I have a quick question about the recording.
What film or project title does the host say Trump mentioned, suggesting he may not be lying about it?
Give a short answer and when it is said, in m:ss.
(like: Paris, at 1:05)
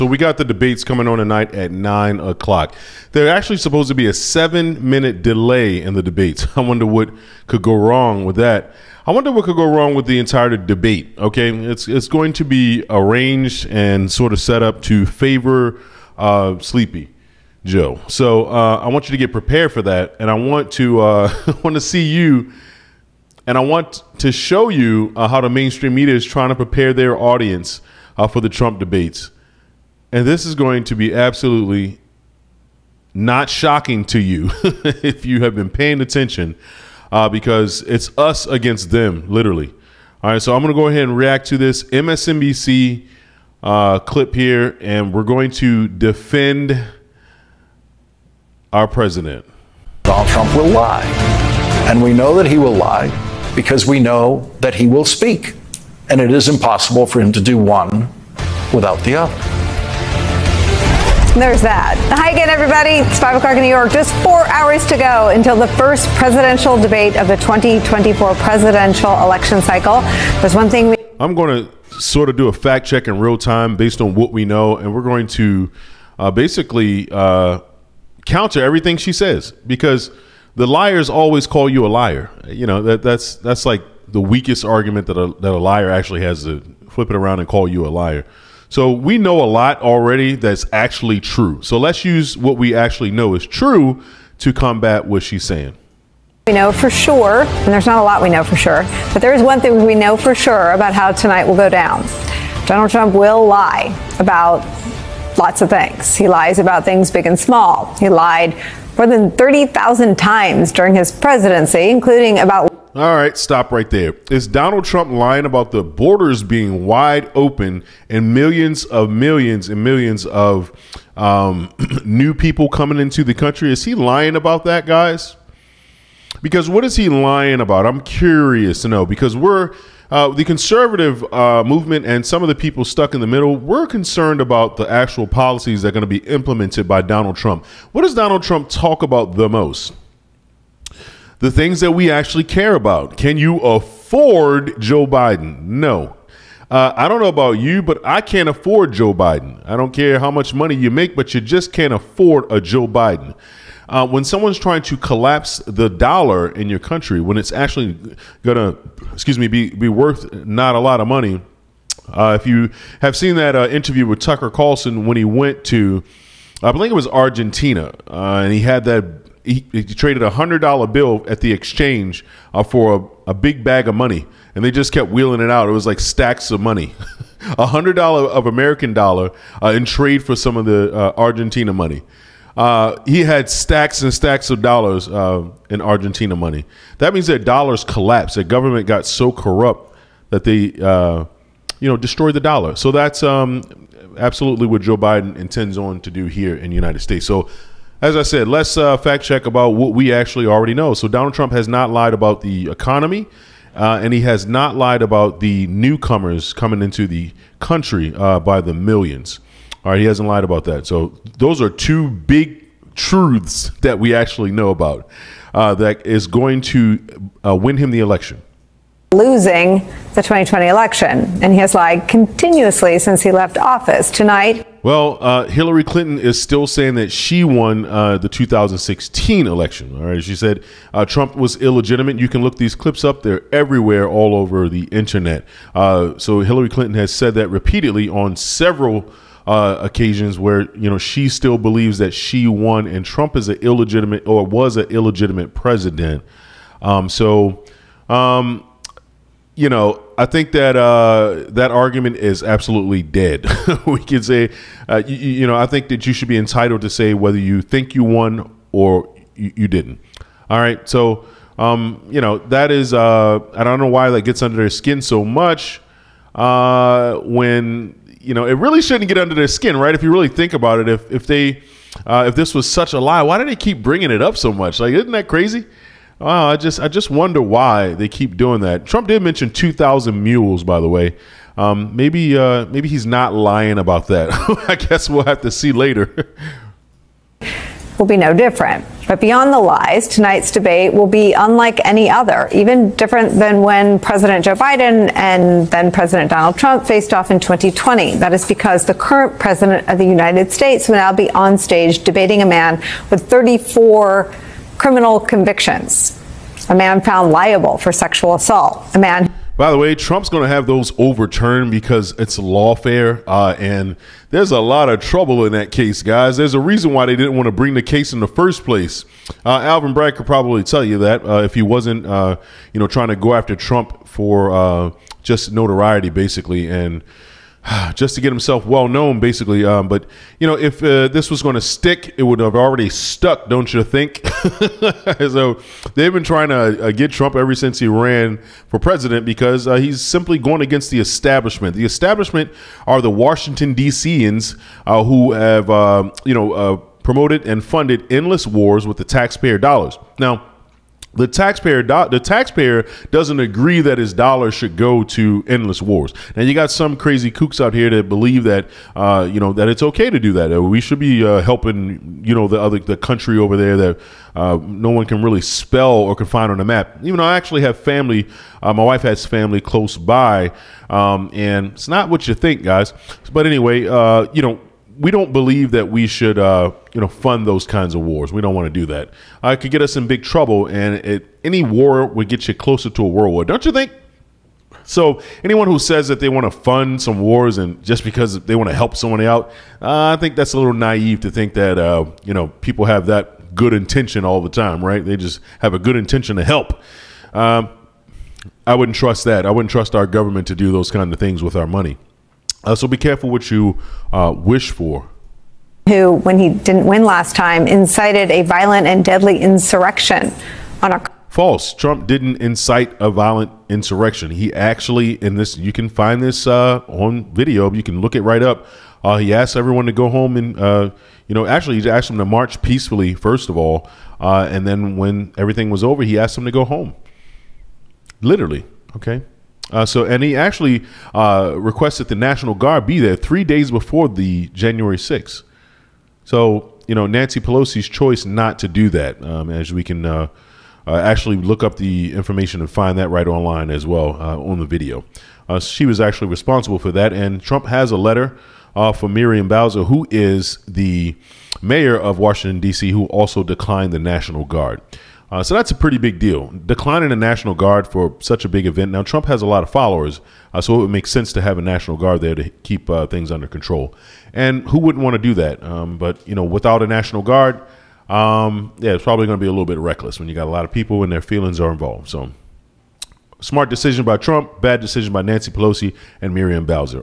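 2,000 Mules, at 4:39.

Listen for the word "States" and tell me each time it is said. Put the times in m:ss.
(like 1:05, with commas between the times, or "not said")
3:17, 5:00.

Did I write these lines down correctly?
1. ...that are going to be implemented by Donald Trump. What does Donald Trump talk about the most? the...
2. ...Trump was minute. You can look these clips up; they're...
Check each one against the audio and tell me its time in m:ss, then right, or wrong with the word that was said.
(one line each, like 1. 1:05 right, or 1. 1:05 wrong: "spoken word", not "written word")
1. 2:15 right
2. 3:51 wrong: "illegitimate", not "minute".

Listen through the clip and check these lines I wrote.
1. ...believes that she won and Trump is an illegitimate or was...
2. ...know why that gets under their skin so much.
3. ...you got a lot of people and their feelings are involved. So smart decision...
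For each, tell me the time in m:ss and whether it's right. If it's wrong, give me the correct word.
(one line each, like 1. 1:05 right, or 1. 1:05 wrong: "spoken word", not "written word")
1. 4:01 right
2. 4:23 right
3. 7:50 right.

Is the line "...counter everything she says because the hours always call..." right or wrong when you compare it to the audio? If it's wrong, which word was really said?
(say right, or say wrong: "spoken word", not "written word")
wrong: "liars", not "hours".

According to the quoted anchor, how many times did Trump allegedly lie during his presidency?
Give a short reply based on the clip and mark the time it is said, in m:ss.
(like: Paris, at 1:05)
More than 30,000, at 1:48.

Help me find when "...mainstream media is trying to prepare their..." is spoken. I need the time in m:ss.
0:25.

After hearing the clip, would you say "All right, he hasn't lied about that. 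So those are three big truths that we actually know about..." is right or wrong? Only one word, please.
wrong.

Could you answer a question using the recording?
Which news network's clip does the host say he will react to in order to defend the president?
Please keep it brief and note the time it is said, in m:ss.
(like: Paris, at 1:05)
MSNBC, at 0:41.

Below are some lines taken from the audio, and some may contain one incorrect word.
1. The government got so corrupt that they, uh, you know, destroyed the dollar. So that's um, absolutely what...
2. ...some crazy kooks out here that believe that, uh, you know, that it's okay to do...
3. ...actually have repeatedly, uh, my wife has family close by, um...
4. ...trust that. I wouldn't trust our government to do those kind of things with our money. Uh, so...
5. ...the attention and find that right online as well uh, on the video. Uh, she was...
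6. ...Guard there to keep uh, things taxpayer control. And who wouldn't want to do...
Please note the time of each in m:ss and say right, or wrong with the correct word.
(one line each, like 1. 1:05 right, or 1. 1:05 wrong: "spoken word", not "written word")
1. 3:08 right
2. 5:56 right
3. 6:07 wrong: "family", not "repeatedly"
4. 6:38 right
5. 7:21 wrong: "information", not "attention"
6. 7:41 wrong: "under", not "taxpayer".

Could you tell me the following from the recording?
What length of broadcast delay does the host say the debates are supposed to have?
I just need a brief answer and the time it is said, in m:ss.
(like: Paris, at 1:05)
7 minutes, at 0:04.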